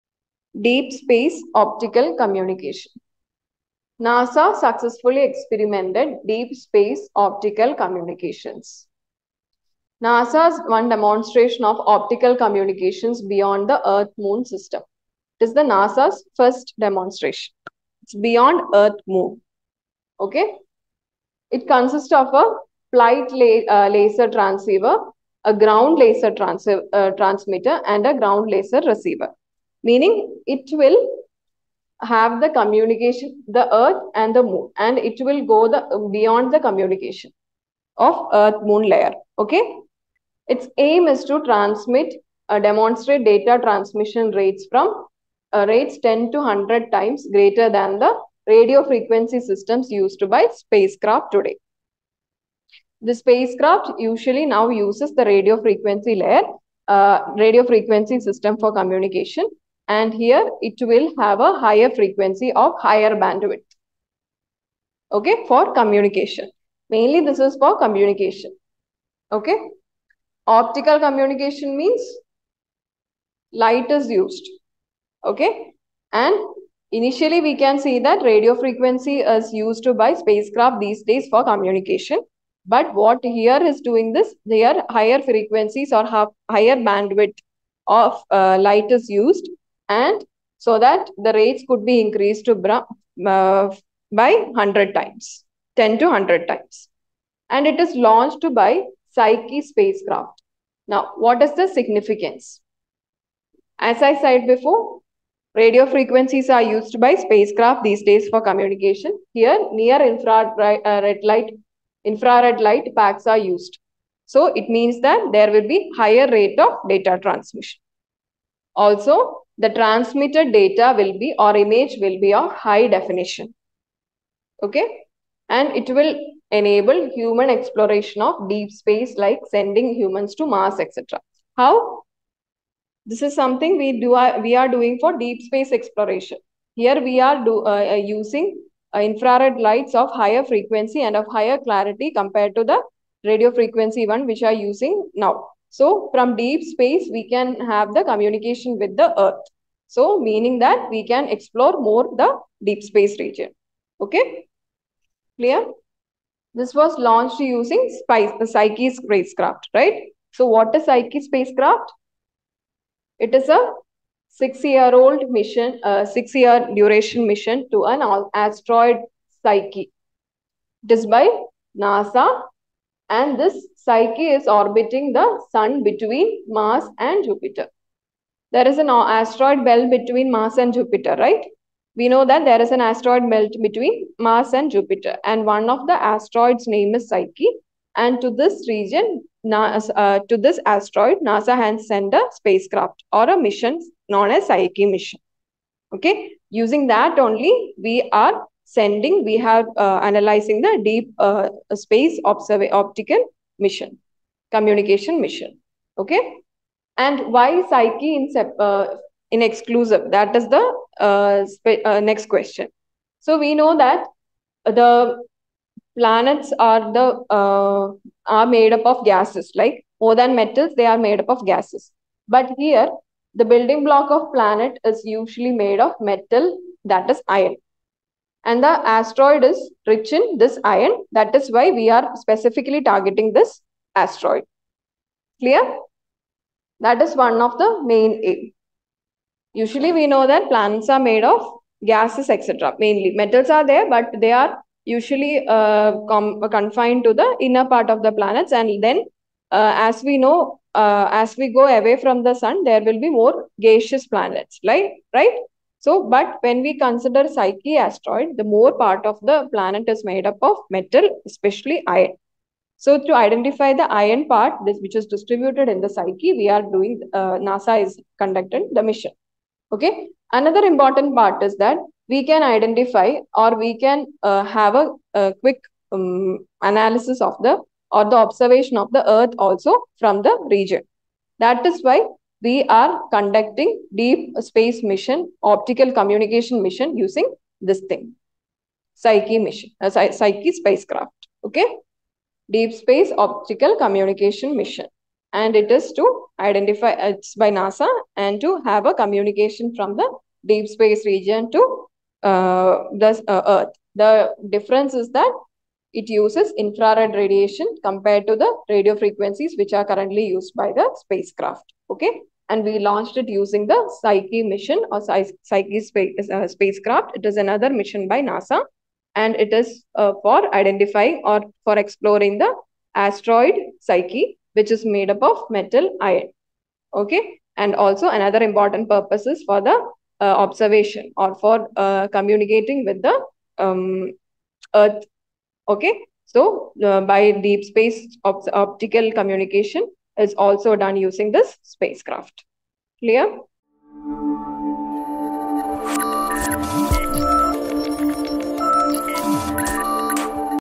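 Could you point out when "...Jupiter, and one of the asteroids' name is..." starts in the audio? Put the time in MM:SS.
03:04.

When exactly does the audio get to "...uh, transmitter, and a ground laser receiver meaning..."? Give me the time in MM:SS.
00:26.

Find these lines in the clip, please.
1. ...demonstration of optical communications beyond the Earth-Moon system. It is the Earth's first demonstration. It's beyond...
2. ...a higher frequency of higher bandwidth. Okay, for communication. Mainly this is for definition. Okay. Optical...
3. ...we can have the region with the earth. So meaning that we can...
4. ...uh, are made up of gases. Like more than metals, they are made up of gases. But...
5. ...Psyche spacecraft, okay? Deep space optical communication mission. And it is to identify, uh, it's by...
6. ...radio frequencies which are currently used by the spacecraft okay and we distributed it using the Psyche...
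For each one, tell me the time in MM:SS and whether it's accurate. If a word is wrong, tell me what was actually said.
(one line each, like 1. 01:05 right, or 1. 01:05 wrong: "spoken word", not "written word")
1. 00:10 wrong: "NASA", not "Earth"
2. 01:01 wrong: "communication", not "definition"
3. 02:27 wrong: "communication", not "region"
4. 03:37 right
5. 04:49 right
6. 05:08 wrong: "launched", not "distributed".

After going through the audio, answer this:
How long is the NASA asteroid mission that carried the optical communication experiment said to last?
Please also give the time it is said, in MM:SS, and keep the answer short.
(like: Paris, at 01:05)
6 years, at 02:46.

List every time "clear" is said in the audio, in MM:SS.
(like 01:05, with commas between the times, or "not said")
02:35, 03:55, 05:42.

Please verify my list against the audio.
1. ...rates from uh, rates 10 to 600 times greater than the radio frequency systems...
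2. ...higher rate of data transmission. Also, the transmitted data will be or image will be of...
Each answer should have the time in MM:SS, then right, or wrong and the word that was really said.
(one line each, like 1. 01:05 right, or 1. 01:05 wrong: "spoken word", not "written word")
1. 00:44 wrong: "100", not "600"
2. 01:55 right.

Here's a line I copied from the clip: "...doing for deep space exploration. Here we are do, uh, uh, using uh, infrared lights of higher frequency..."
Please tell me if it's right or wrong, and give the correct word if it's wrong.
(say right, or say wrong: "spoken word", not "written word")
right.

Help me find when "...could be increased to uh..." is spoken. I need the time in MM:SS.
01:31.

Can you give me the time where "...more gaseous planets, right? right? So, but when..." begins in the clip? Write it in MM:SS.
04:13.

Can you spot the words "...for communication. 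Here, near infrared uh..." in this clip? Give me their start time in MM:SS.
01:48.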